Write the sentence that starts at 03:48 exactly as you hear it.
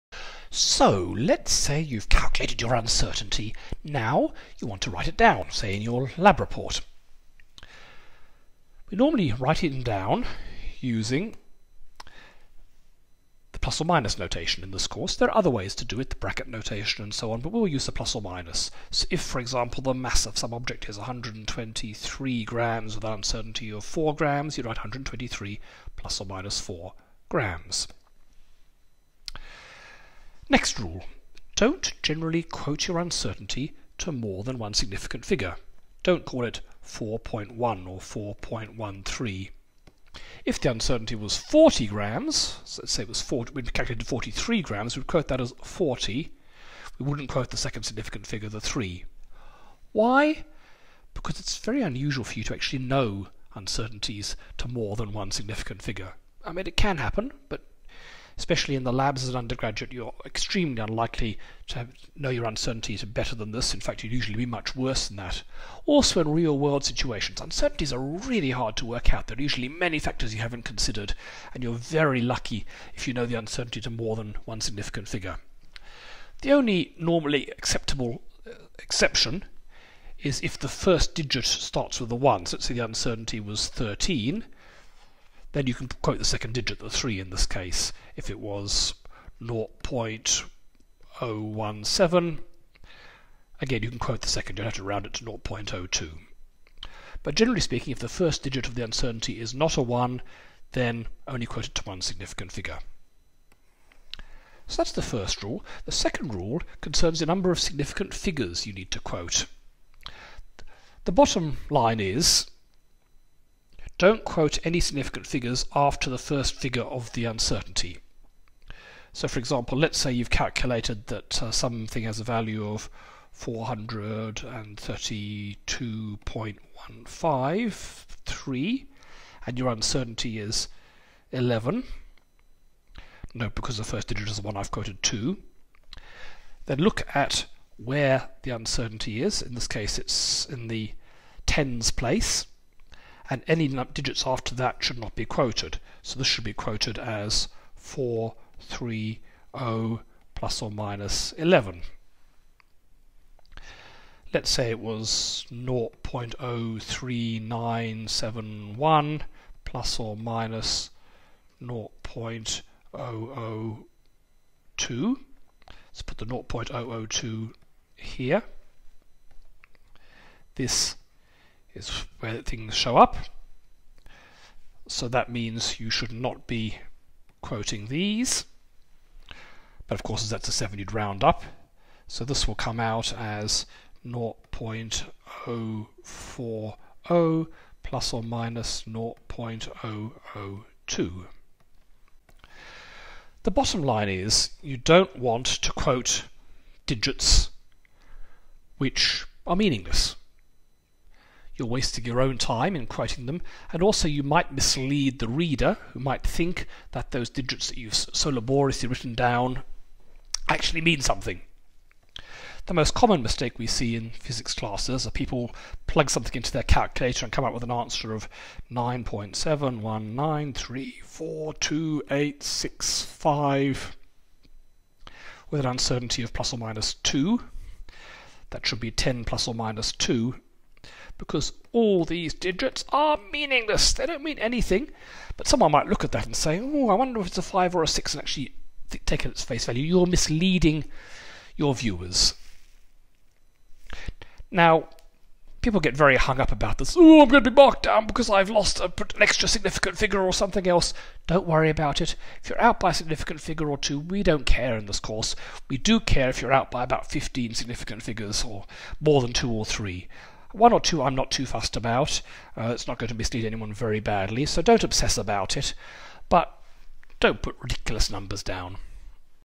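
That should be 10 plus or minus 2 because all these digits are meaningless.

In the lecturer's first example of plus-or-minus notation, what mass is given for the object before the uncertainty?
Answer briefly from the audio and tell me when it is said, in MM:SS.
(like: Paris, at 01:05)
123 grams, at 00:20.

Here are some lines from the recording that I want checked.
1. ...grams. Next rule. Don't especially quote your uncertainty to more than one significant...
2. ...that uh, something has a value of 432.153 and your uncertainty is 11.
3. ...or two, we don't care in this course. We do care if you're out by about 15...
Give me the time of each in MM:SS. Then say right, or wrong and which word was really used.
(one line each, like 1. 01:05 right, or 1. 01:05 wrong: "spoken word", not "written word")
1. 00:27 wrong: "generally", not "especially"
2. 02:01 right
3. 04:13 right.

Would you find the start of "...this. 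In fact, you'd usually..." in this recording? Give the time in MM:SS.
01:03.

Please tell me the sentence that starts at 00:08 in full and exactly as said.
We normally write it down using the plus or minus notation in this course.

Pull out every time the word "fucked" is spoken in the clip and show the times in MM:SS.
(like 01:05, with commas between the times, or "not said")
not said.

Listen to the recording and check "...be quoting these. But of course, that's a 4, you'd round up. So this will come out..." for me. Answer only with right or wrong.
wrong.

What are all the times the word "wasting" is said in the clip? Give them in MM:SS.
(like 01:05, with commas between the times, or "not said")
03:21.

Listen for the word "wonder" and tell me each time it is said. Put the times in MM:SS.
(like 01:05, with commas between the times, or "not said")
03:56.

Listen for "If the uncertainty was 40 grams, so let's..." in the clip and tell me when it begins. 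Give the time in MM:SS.
00:40.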